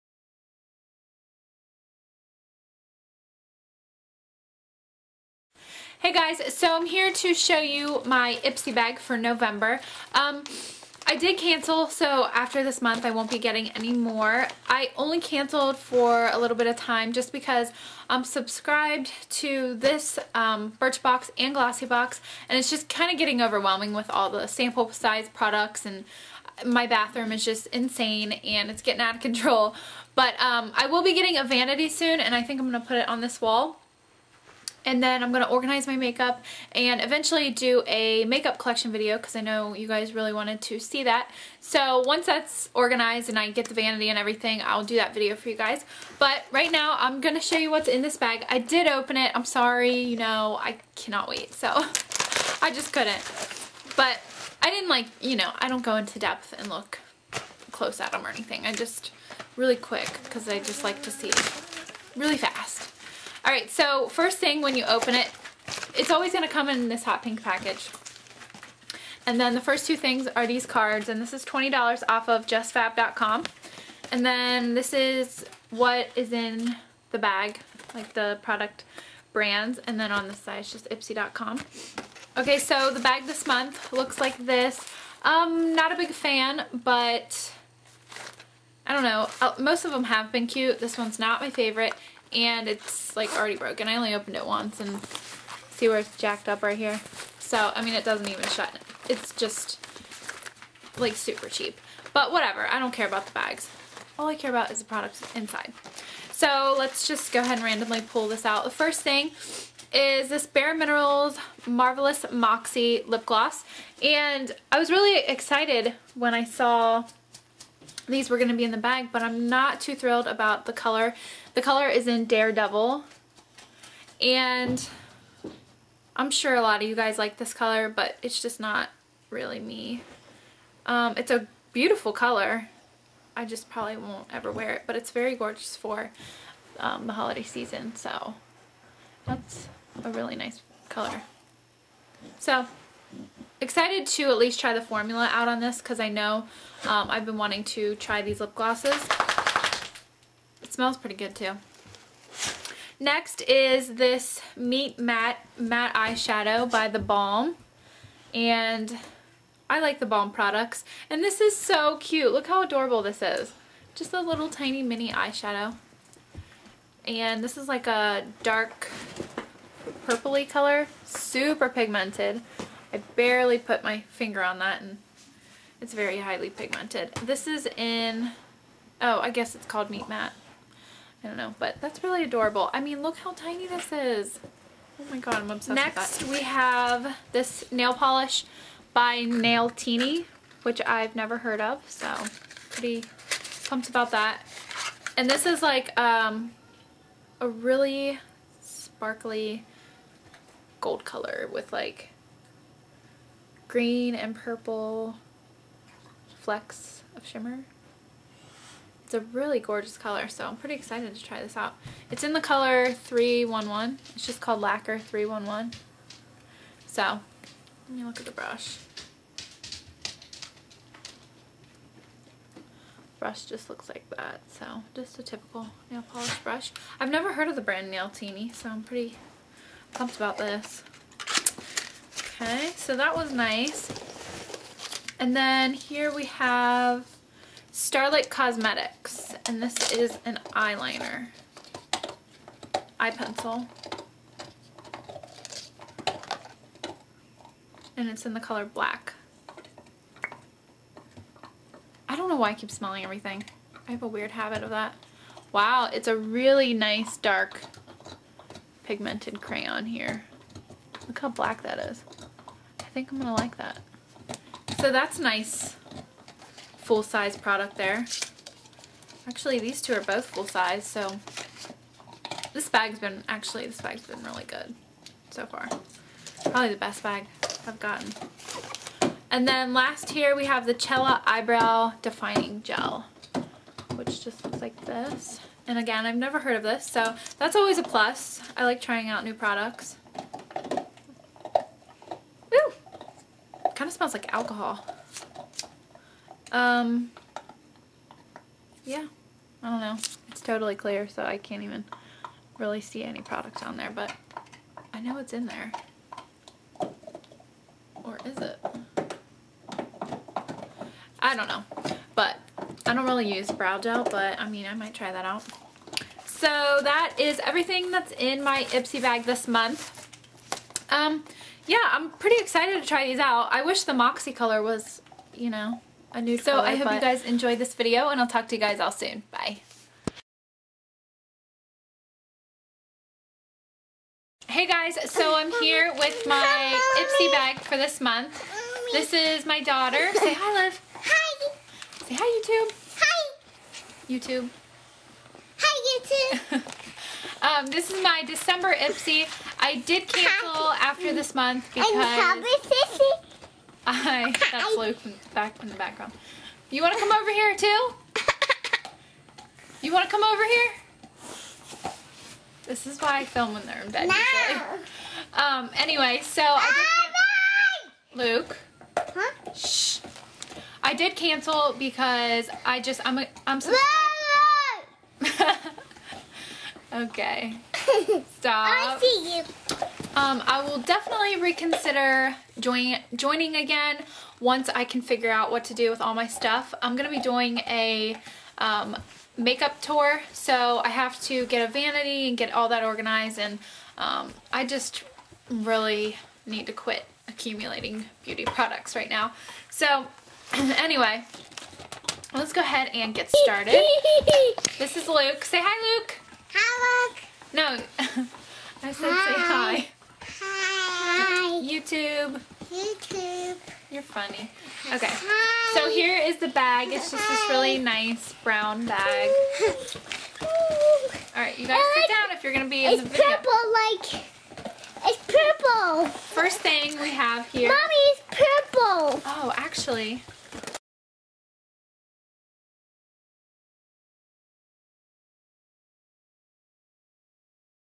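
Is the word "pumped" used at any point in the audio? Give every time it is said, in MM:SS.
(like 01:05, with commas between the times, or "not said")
03:13, 03:49.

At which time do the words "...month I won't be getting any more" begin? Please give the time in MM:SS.
00:12.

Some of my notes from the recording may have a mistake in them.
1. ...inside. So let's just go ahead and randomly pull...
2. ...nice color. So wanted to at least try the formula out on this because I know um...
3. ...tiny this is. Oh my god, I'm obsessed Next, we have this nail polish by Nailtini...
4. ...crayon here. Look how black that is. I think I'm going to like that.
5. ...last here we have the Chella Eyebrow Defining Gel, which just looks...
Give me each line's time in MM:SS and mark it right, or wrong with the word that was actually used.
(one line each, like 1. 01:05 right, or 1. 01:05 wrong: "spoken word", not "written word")
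1. 01:45 right
2. 02:20 wrong: "excited", not "wanted"
3. 03:03 right
4. 04:19 right
5. 04:39 right.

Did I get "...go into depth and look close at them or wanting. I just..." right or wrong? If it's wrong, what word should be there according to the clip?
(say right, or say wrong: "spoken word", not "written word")
wrong: "anything", not "wanting".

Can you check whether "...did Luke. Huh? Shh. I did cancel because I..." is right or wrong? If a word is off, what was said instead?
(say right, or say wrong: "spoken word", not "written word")
right.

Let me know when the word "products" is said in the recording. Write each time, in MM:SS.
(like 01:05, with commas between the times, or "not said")
00:25, 01:18, 01:44, 02:40, 04:27, 04:49, 05:03, 06:38.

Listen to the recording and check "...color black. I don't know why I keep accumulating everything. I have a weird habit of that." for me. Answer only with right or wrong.
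wrong.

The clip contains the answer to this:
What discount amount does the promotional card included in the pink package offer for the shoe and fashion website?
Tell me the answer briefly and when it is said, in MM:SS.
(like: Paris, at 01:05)
$20, at 01:11.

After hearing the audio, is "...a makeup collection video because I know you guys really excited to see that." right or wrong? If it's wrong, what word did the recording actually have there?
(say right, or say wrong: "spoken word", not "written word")
wrong: "wanted", not "excited".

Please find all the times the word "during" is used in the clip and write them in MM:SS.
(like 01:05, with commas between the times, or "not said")
not said.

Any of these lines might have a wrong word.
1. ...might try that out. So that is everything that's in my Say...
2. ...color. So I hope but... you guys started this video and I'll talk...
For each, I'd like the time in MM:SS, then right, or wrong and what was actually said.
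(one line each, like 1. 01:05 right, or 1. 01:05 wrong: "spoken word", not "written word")
1. 05:14 wrong: "Ipsy", not "Say"
2. 05:26 wrong: "enjoyed", not "started".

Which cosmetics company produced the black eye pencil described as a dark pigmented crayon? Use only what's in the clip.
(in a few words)
Starlet Cosmetics.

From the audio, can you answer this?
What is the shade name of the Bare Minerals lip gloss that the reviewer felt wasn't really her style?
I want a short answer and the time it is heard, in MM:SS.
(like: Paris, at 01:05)
Daredevil, at 02:02.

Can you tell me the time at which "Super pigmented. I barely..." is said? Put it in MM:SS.
02:51.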